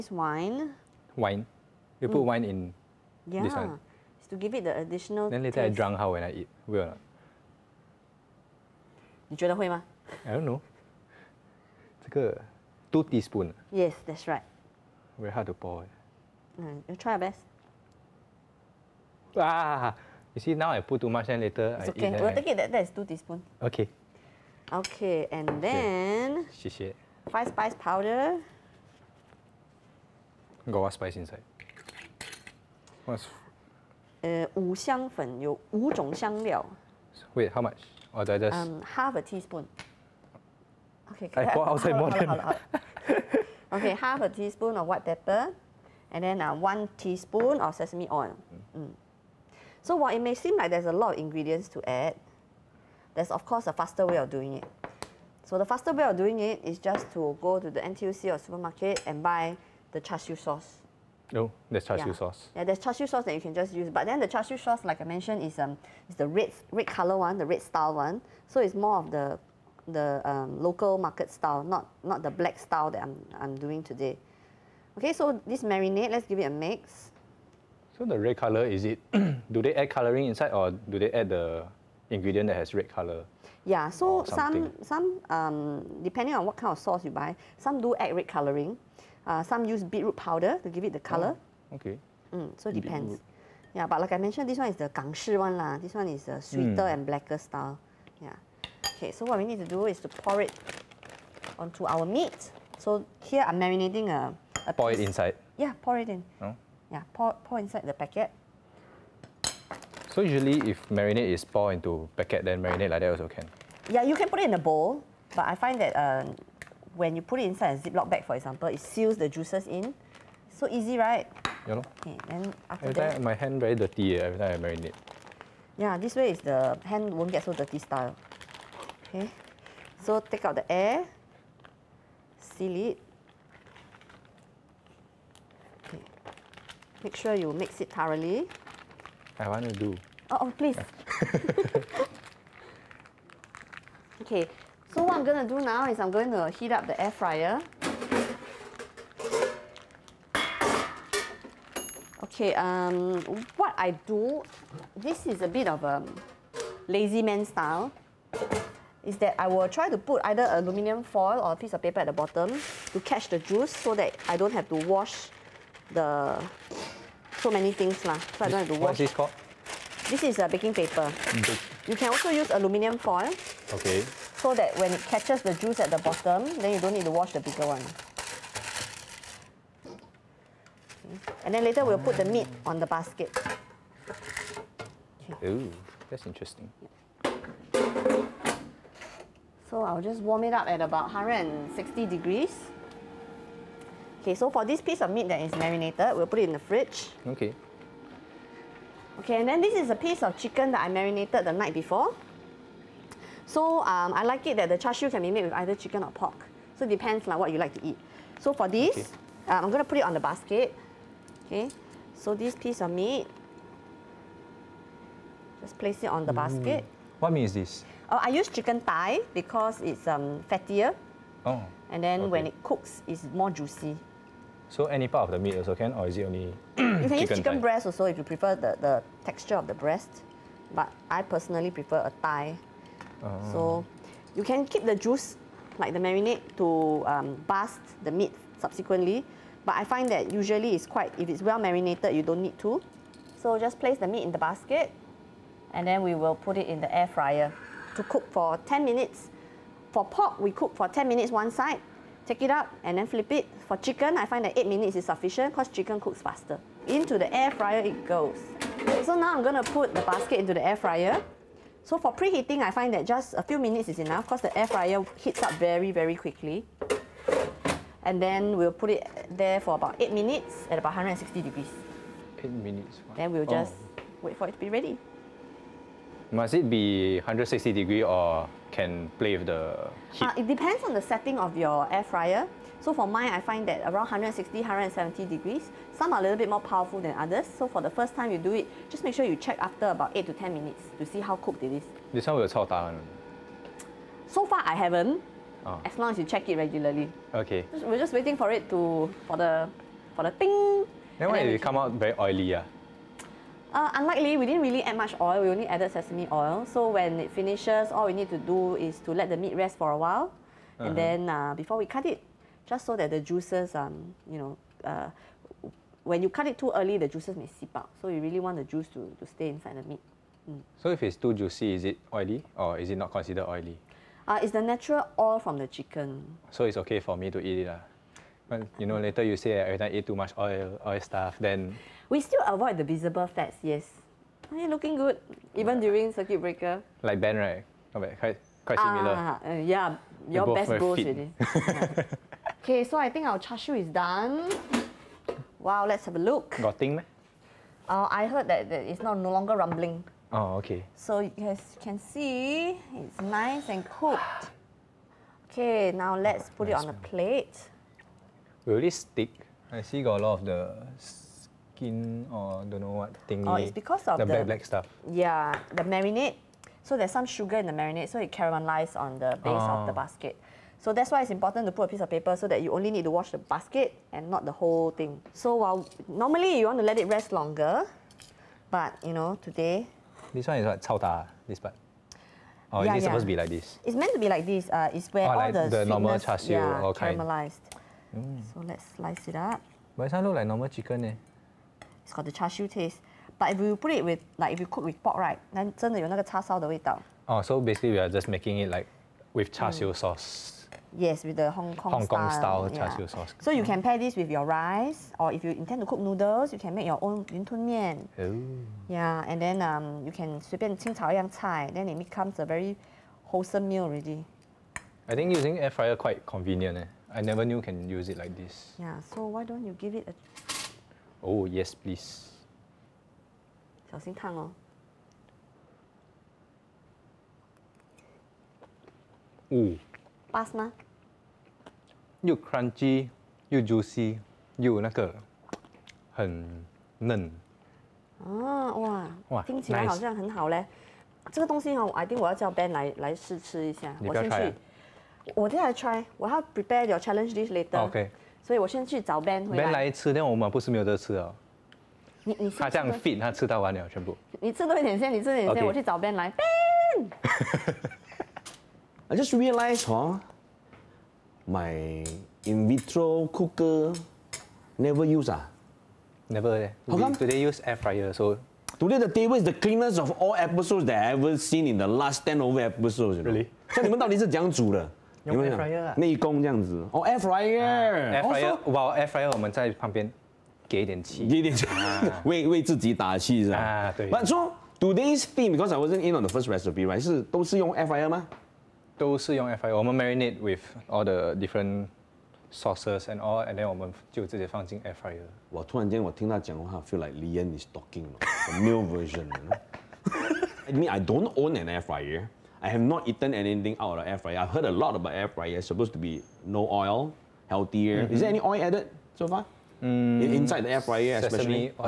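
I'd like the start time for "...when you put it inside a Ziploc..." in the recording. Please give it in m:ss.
1:56.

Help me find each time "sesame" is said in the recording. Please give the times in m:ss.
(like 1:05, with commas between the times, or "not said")
0:47, 5:05.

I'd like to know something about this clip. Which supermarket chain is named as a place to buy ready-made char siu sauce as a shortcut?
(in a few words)
NTUC.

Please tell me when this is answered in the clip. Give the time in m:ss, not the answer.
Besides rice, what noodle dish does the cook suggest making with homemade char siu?
6:47.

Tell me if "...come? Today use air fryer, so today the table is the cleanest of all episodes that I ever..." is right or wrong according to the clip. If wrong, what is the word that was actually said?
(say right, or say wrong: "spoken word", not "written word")
right.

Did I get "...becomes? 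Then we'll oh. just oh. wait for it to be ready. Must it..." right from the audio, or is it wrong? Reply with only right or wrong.
wrong.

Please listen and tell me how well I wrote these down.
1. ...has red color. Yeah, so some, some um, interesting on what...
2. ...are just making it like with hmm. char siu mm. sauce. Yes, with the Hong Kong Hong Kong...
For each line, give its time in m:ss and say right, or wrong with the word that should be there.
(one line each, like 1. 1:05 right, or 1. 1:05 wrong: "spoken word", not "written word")
1. 1:22 wrong: "depending", not "interesting"
2. 6:37 right.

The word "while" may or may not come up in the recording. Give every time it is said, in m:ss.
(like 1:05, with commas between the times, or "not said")
0:49, 5:09, 6:15.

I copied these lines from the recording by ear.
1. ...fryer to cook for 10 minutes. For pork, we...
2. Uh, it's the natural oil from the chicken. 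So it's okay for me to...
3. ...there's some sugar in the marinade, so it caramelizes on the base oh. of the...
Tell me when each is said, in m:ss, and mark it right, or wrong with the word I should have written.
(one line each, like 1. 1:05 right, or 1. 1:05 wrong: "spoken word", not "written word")
1. 4:07 right
2. 5:24 right
3. 6:06 right.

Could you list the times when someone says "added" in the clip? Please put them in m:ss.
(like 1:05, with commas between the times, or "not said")
5:05, 8:28.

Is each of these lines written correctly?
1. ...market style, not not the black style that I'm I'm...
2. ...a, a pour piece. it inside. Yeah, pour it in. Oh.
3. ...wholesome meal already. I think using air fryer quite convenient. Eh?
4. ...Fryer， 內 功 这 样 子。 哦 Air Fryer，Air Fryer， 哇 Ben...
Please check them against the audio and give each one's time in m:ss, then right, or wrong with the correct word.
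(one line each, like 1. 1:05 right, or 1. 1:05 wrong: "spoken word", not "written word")
1. 1:10 right
2. 1:44 right
3. 6:53 right
4. 7:55 wrong: "Air", not "Ben".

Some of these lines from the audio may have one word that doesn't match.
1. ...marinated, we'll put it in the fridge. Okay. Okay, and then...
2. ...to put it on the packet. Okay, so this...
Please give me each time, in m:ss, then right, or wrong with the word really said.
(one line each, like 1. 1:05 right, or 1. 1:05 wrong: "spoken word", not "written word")
1. 3:15 right
2. 3:29 wrong: "basket", not "packet".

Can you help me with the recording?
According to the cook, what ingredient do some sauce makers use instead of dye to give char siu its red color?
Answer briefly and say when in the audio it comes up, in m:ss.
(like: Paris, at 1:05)
Beetroot powder, at 1:29.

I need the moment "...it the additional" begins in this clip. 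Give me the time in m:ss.
0:04.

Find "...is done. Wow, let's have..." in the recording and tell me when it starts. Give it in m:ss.
5:43.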